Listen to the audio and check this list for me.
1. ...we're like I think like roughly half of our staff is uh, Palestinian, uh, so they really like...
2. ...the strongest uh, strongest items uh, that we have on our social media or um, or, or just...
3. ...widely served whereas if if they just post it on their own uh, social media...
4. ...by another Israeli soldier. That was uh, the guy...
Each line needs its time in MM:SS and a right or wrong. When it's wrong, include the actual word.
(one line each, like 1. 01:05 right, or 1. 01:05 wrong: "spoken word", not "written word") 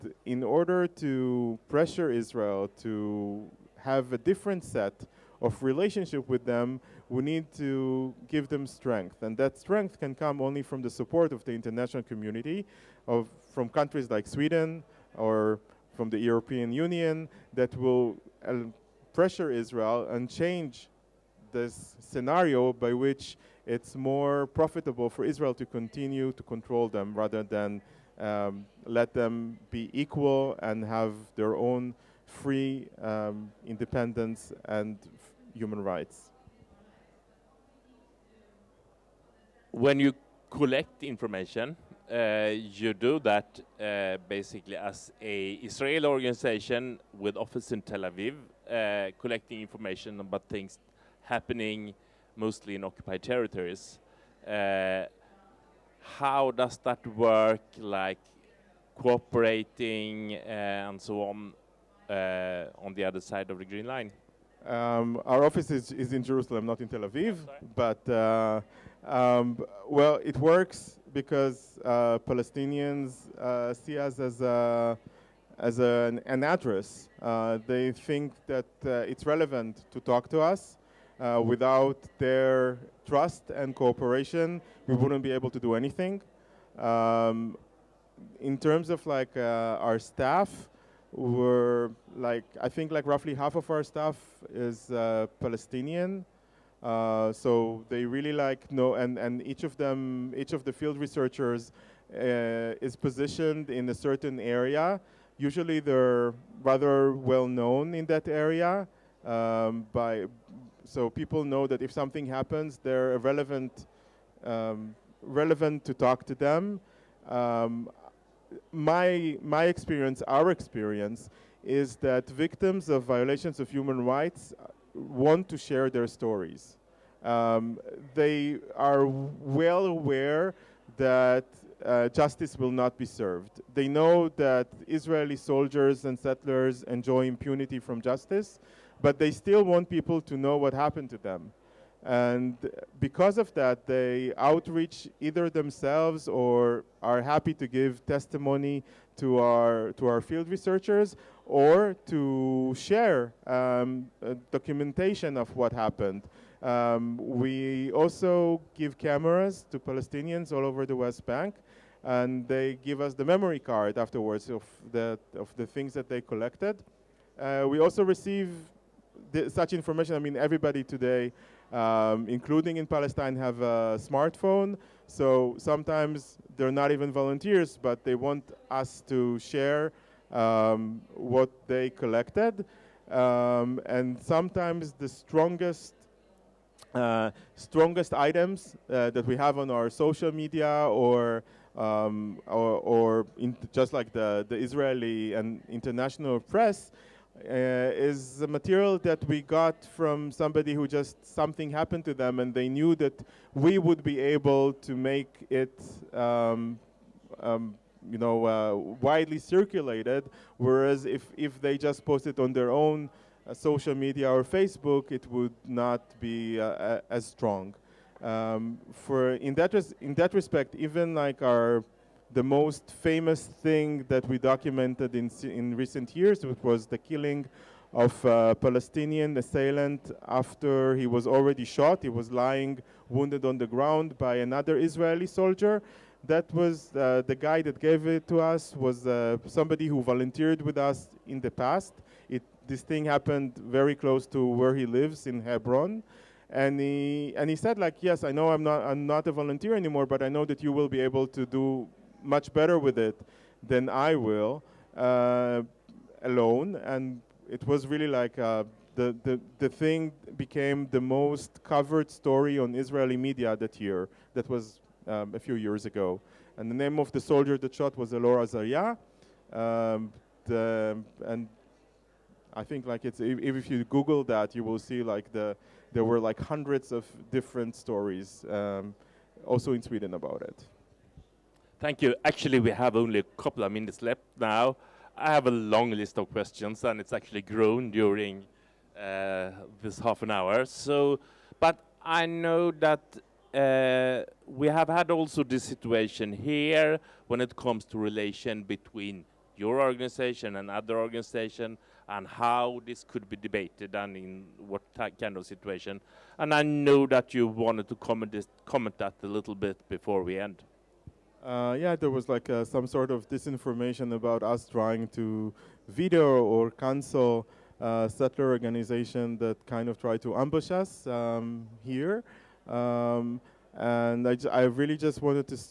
1. 01:31 right
2. 03:04 right
3. 03:29 wrong: "circulated", not "served"
4. 03:54 right.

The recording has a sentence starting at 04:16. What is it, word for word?
And it was really like uh, the, the, the thing became the most covered story on Israeli media that year.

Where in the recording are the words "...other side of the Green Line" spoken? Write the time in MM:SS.
01:03.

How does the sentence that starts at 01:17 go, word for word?
Uh, they think that uh, it's relevant to talk to us.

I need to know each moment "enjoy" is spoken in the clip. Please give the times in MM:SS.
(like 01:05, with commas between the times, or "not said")
02:16.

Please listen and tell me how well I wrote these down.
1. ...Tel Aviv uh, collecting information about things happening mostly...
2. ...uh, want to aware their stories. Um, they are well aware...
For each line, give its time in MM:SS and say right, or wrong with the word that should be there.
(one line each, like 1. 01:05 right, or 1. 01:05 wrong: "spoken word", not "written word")
1. 00:47 right
2. 02:04 wrong: "share", not "aware".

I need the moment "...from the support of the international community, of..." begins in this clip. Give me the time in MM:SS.
00:10.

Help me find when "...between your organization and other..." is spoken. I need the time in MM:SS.
04:58.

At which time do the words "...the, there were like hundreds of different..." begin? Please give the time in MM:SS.
04:35.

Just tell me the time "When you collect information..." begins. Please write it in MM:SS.
00:39.